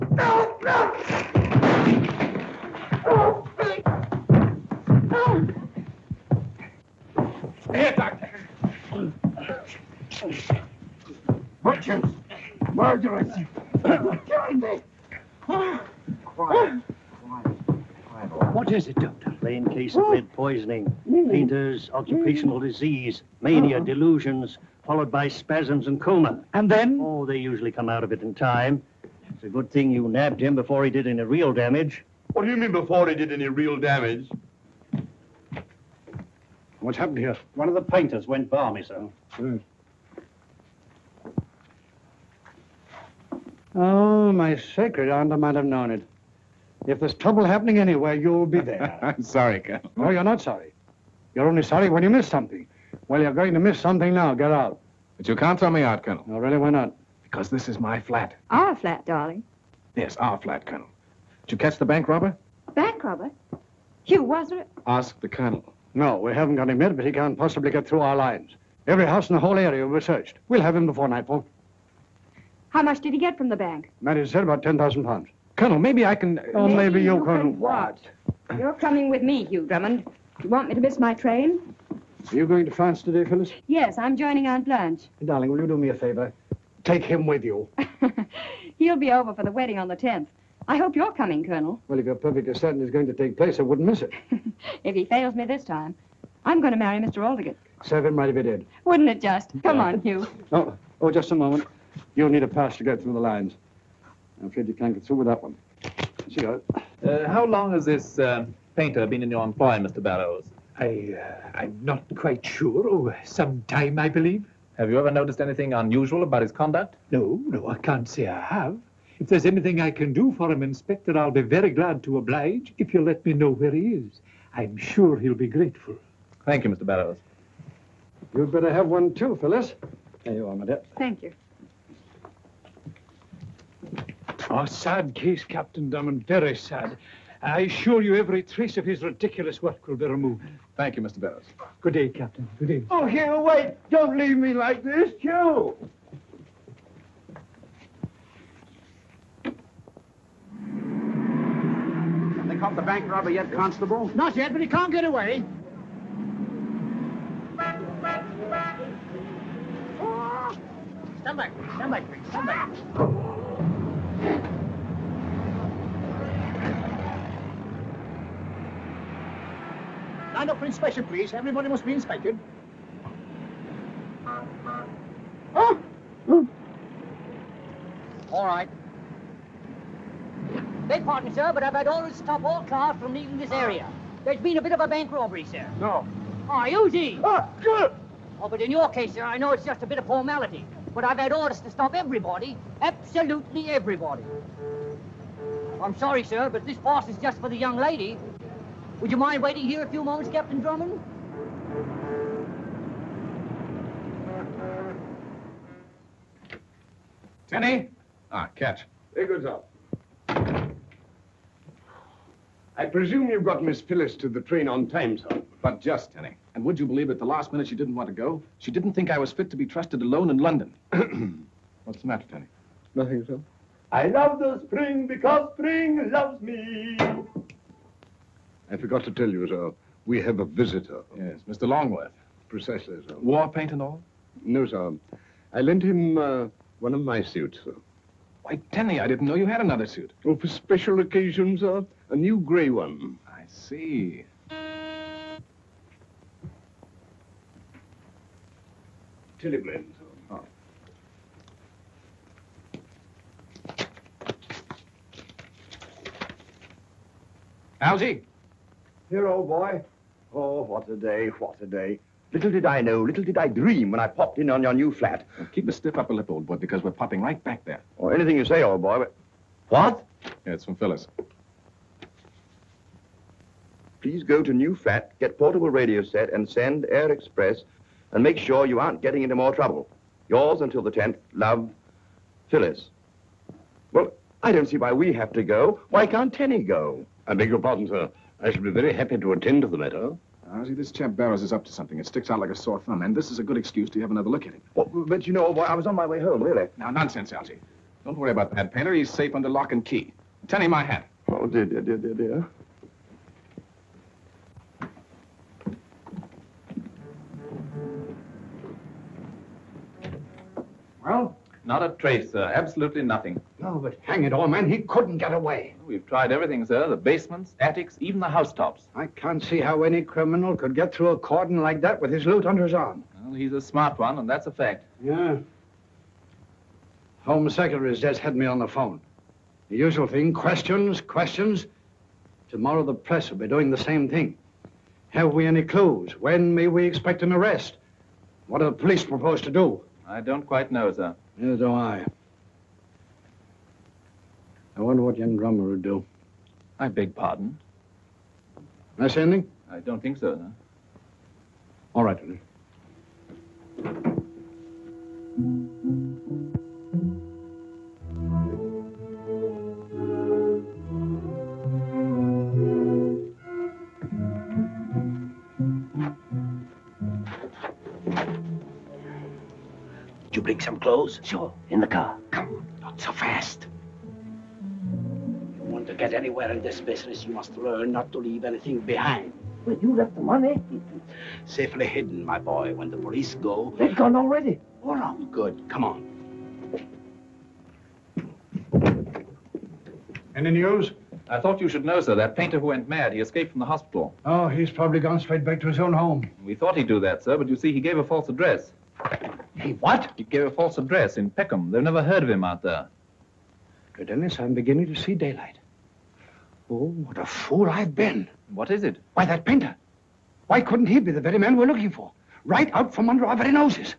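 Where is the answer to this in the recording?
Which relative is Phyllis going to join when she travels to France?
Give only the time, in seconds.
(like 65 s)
84 s.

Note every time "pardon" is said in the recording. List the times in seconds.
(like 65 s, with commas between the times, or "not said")
181 s, 287 s, 347 s.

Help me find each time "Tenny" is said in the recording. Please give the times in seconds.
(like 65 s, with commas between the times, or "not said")
207 s, 216 s, 222 s, 238 s, 286 s.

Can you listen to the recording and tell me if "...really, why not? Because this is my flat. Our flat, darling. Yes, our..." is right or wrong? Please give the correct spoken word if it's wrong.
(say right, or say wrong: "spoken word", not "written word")
right.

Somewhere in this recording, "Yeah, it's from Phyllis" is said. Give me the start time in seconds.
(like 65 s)
270 s.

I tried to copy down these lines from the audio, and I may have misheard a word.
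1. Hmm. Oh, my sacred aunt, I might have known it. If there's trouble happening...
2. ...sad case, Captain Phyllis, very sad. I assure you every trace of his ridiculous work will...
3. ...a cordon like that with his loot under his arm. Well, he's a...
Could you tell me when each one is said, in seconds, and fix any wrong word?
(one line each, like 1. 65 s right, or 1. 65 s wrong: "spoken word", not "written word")
1. 39 s right
2. 134 s wrong: "Drummond", not "Phyllis"
3. 321 s right.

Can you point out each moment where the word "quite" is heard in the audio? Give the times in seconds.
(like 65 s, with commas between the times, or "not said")
112 s, 340 s.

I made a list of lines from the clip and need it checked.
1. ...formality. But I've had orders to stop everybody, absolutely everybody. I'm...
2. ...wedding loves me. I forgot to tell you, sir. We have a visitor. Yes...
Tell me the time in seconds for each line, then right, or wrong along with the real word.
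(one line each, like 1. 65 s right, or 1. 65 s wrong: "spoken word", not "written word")
1. 190 s right
2. 225 s wrong: "spring", not "wedding".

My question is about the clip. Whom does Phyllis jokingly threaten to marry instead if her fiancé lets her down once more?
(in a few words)
Mr. Aldergate.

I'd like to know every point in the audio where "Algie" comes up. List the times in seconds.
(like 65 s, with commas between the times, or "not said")
257 s, 297 s.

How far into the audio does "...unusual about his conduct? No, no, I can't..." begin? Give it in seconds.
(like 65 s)
115 s.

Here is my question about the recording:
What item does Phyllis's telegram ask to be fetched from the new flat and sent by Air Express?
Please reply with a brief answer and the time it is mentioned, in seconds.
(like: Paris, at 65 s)
portable radio set, at 275 s.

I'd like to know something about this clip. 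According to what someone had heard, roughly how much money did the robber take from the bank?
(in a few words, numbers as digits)
10,000 pounds.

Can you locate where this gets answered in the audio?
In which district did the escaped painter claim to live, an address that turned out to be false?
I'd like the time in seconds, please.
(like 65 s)
401 s.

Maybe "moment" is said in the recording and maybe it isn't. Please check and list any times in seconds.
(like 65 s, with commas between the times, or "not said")
101 s, 200 s.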